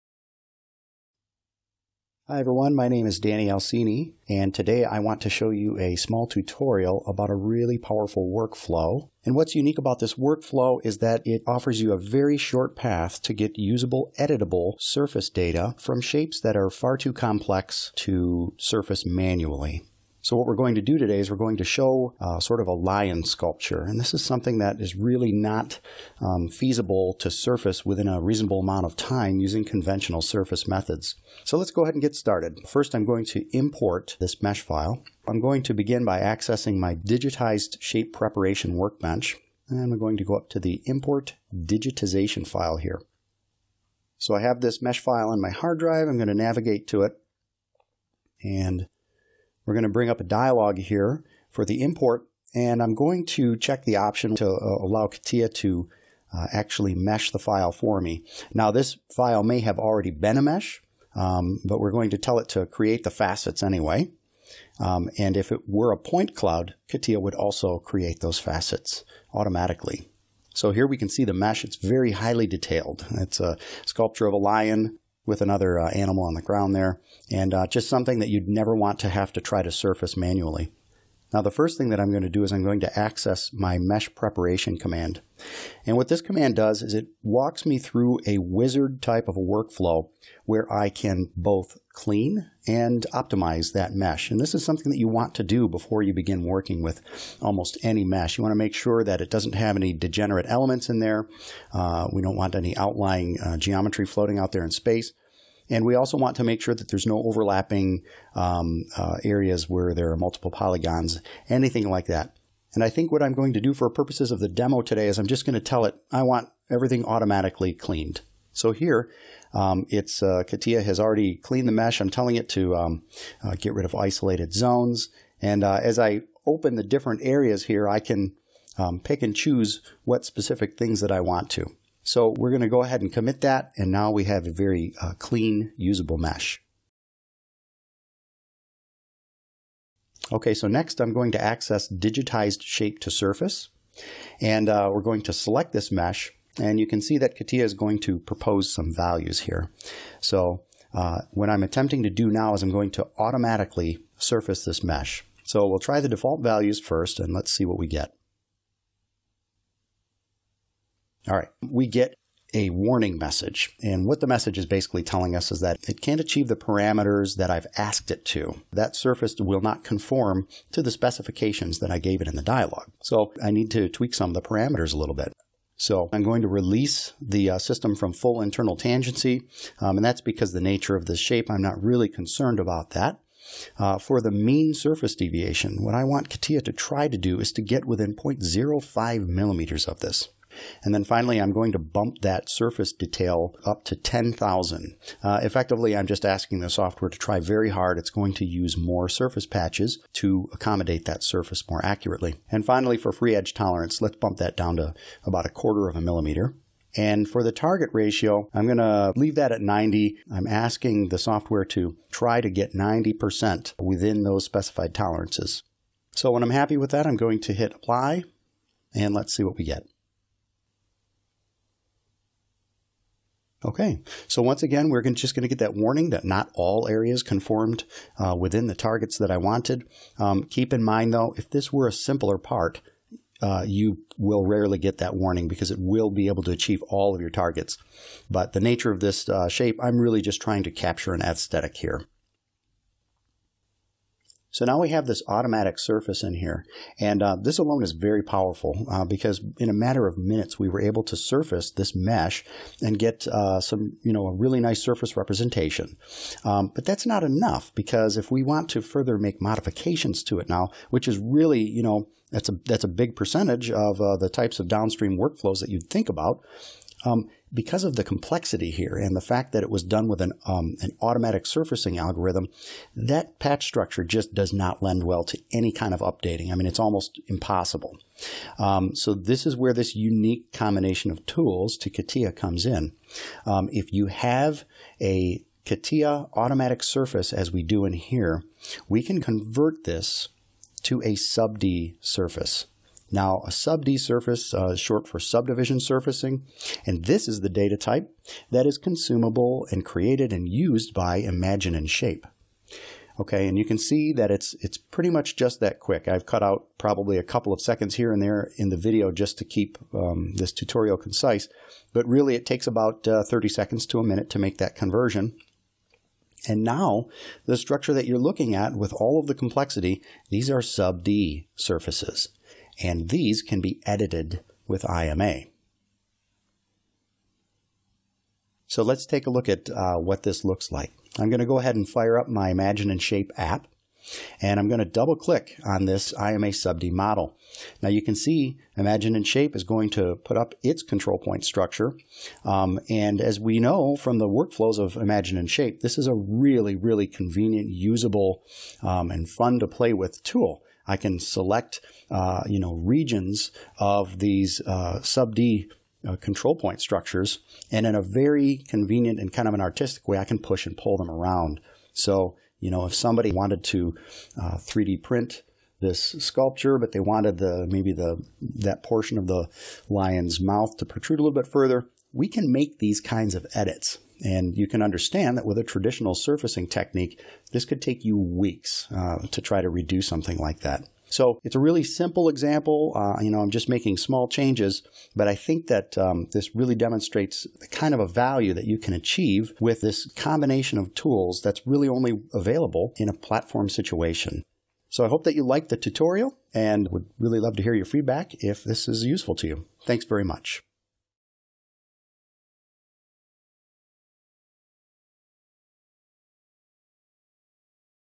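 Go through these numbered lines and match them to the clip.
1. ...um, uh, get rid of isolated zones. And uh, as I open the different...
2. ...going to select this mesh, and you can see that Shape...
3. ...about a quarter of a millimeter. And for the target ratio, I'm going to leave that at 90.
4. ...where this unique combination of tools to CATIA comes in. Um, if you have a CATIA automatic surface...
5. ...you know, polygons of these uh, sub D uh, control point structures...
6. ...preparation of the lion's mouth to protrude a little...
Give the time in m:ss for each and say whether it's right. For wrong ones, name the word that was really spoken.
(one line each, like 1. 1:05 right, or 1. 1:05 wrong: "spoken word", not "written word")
1. 2:02 right
2. 2:25 wrong: "CATIA", not "Shape"
3. 3:25 right
4. 4:39 right
5. 5:52 wrong: "regions", not "polygons"
6. 6:08 wrong: "portion", not "preparation".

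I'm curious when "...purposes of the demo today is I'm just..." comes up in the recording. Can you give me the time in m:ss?
1:53.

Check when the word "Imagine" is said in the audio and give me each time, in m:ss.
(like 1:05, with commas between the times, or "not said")
5:01, 5:32, 5:38, 5:44.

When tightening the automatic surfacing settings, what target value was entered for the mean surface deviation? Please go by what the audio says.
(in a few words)
0.05 millimeters.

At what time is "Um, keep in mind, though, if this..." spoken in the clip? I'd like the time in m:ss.
3:50.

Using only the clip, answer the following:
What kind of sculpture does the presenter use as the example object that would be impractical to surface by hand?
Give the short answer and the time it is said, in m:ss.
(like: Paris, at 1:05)
Lion sculpture, at 0:22.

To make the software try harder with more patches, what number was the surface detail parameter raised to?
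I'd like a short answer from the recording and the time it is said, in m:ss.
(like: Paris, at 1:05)
10,000, at 3:13.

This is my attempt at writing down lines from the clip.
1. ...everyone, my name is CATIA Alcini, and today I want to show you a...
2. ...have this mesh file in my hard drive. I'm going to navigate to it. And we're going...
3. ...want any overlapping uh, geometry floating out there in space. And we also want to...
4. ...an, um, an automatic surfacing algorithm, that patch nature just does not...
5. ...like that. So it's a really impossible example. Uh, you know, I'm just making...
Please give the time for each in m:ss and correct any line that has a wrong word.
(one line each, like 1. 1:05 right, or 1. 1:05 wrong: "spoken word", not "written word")
1. 0:02 wrong: "Danny", not "CATIA"
2. 0:44 right
3. 1:42 wrong: "outlying", not "overlapping"
4. 4:30 wrong: "structure", not "nature"
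5. 6:20 wrong: "simple", not "impossible".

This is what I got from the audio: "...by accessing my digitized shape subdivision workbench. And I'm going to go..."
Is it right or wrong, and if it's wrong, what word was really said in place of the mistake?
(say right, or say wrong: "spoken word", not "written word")
wrong: "preparation", not "subdivision".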